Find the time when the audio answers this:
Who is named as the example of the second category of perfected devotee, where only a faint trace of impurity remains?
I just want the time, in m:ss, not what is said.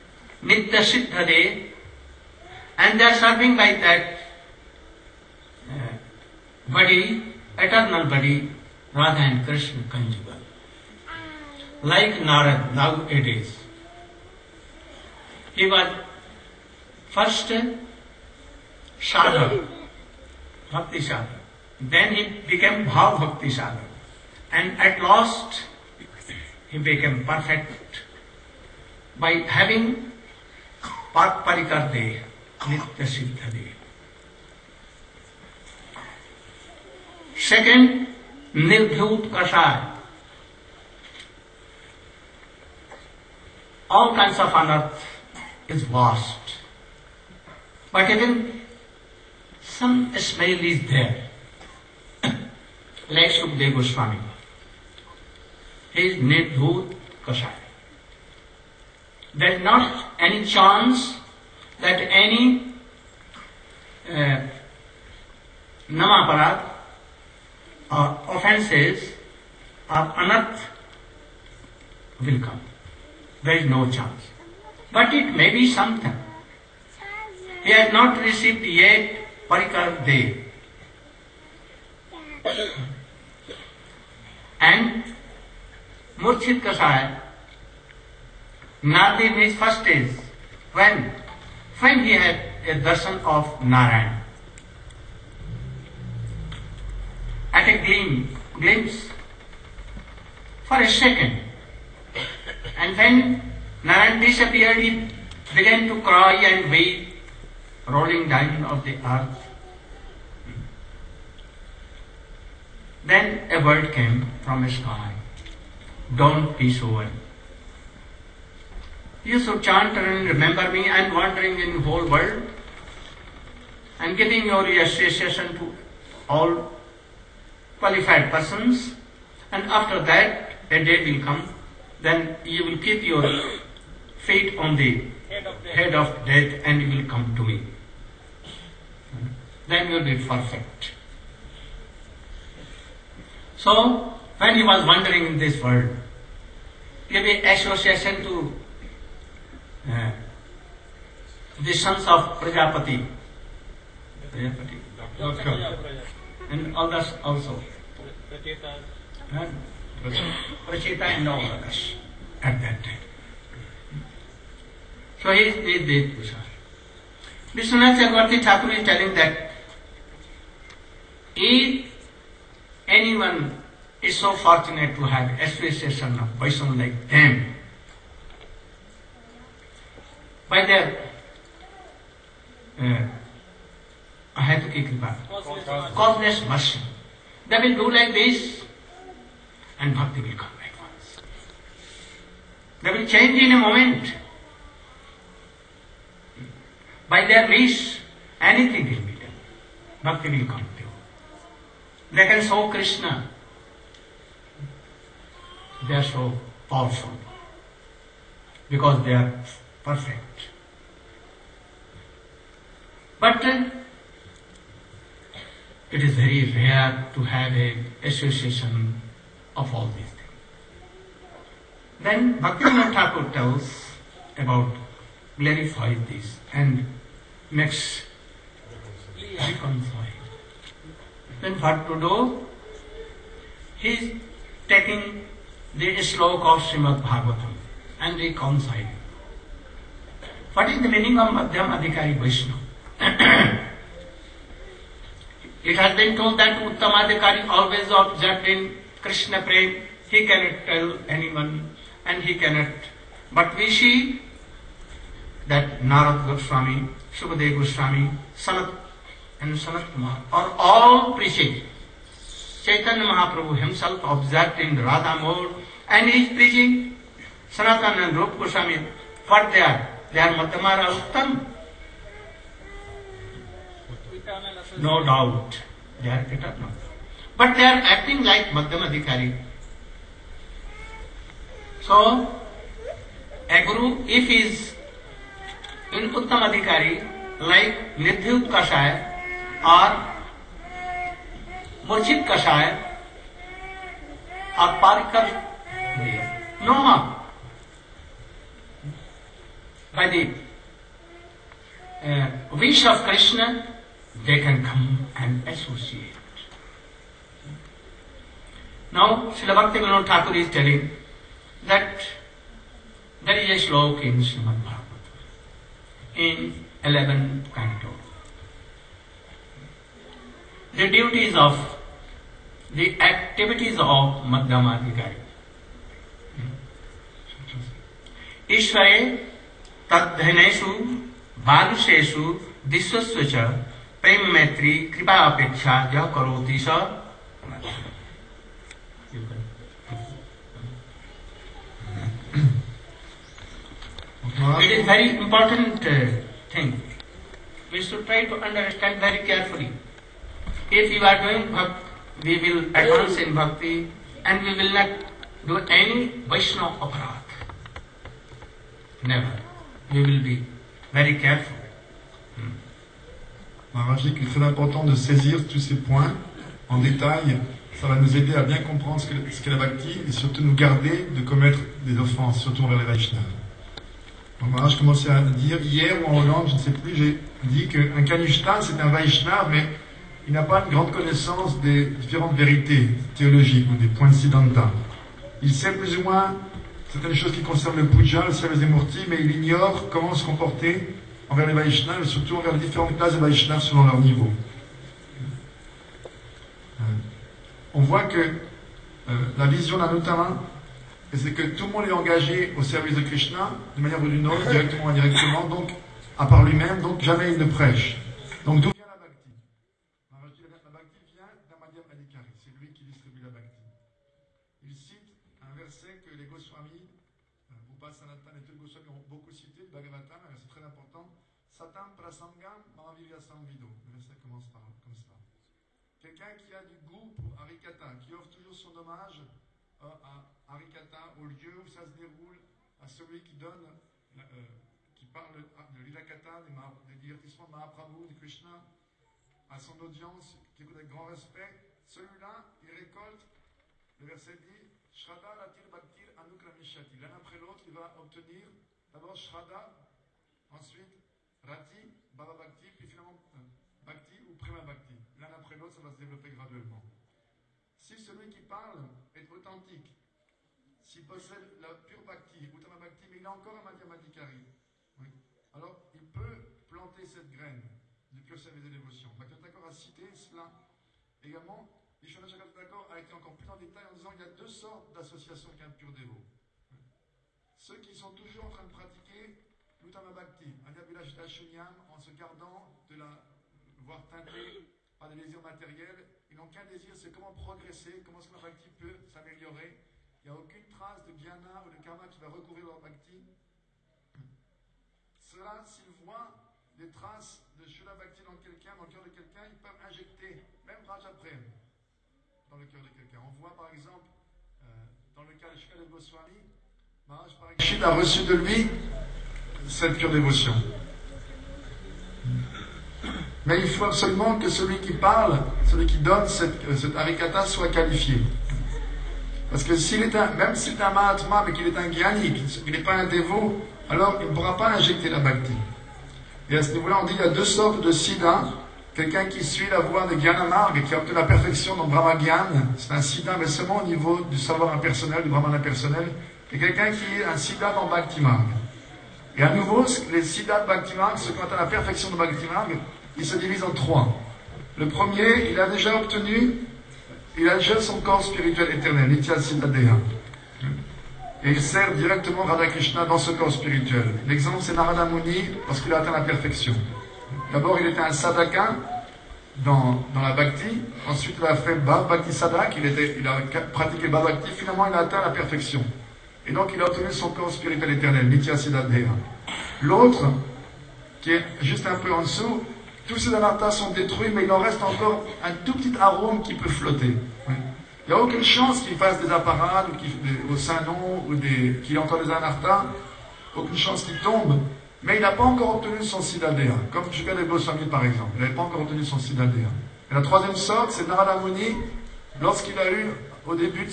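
0:53.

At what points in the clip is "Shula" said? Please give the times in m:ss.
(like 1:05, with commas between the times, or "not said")
8:17.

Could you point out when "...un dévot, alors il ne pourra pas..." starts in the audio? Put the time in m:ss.
8:42.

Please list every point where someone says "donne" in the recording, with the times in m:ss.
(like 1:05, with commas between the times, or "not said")
7:13, 8:35.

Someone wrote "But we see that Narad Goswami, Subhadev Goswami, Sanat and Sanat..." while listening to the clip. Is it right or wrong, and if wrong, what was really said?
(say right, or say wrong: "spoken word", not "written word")
right.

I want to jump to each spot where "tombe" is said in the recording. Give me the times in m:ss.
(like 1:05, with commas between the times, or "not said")
9:44.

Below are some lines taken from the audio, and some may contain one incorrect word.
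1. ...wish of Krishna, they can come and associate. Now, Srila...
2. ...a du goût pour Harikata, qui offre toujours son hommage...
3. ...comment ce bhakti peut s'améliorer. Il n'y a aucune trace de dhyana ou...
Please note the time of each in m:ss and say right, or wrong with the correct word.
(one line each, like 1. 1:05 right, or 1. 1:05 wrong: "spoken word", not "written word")
1. 5:02 right
2. 7:06 right
3. 8:08 right.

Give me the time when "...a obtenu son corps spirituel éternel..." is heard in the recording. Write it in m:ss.
9:26.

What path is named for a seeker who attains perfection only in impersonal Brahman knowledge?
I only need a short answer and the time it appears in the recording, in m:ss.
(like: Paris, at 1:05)
Gyanamarg, at 8:50.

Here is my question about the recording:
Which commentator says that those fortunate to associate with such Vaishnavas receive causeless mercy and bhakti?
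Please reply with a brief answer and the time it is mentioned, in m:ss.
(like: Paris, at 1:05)
Vishwanath Chakravarti Thakur, at 2:47.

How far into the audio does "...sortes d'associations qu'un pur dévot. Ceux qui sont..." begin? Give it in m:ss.
7:54.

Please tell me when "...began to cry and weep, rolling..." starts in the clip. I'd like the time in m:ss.
1:45.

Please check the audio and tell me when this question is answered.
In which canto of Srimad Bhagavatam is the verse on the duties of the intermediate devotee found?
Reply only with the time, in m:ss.
5:16.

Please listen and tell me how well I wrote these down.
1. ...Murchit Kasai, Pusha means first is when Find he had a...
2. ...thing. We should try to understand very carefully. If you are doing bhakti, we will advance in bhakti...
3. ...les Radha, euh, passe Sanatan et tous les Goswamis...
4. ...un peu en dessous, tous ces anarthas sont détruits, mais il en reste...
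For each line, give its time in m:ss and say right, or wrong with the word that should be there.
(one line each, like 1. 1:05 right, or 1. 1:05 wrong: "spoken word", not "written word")
1. 1:26 wrong: "Nadi", not "Pusha"
2. 5:46 right
3. 6:56 wrong: "Goswamis", not "Radha"
4. 9:31 right.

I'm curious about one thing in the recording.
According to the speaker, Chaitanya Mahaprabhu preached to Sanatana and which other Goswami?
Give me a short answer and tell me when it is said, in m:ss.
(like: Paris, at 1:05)
Rup Goswami, at 4:28.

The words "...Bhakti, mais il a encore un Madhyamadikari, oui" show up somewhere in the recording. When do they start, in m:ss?
7:42.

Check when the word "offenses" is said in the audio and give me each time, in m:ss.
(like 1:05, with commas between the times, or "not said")
1:08, 6:11.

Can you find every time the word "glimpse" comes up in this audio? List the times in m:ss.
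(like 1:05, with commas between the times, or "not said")
1:38.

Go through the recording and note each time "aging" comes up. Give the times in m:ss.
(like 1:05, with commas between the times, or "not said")
not said.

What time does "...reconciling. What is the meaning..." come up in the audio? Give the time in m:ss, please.
3:58.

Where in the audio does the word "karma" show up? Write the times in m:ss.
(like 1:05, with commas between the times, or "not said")
8:11.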